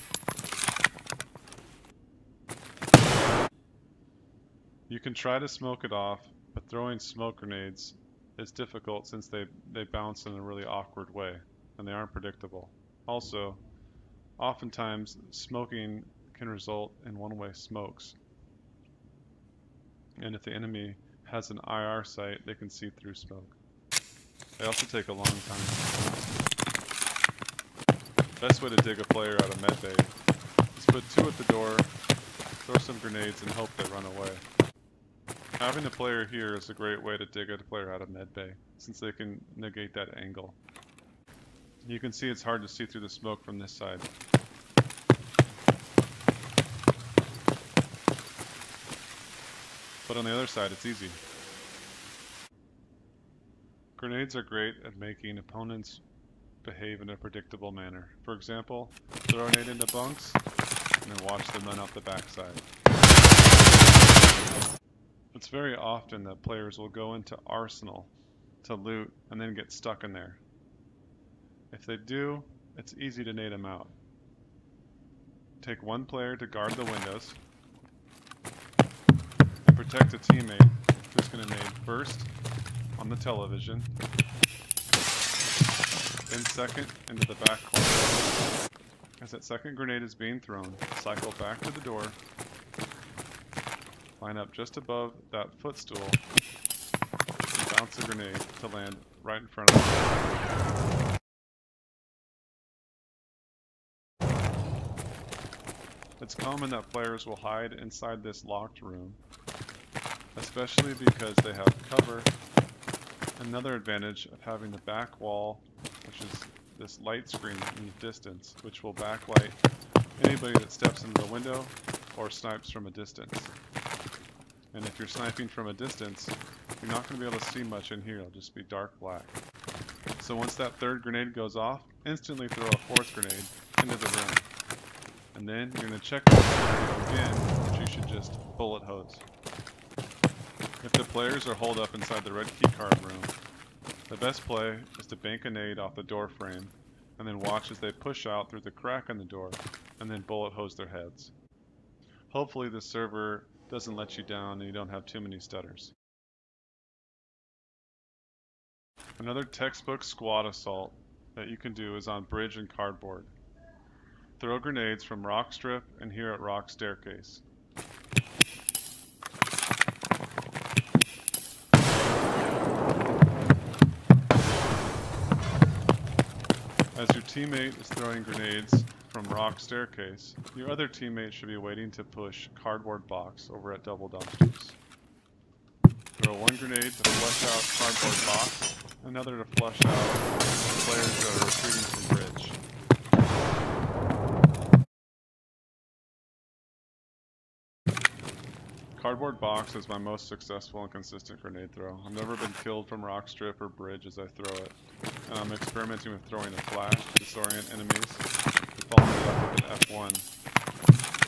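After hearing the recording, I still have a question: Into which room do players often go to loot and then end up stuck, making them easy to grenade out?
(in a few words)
Arsenal.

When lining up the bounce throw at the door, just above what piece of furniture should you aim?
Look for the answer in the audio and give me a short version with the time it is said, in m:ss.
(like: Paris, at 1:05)
footstool, at 1:35.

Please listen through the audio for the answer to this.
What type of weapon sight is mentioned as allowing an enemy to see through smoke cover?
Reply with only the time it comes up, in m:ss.
0:21.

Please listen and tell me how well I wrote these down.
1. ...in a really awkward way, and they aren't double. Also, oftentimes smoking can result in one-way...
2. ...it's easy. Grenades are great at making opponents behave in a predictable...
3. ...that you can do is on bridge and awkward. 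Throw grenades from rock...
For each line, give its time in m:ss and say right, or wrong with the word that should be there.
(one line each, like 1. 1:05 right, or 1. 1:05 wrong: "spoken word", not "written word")
1. 0:10 wrong: "predictable", not "double"
2. 0:50 right
3. 2:41 wrong: "cardboard", not "awkward".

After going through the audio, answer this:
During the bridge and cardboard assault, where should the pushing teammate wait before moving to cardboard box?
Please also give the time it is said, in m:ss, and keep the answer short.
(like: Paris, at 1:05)
double dumpsters, at 3:03.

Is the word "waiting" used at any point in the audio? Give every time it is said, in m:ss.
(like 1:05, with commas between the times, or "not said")
3:01.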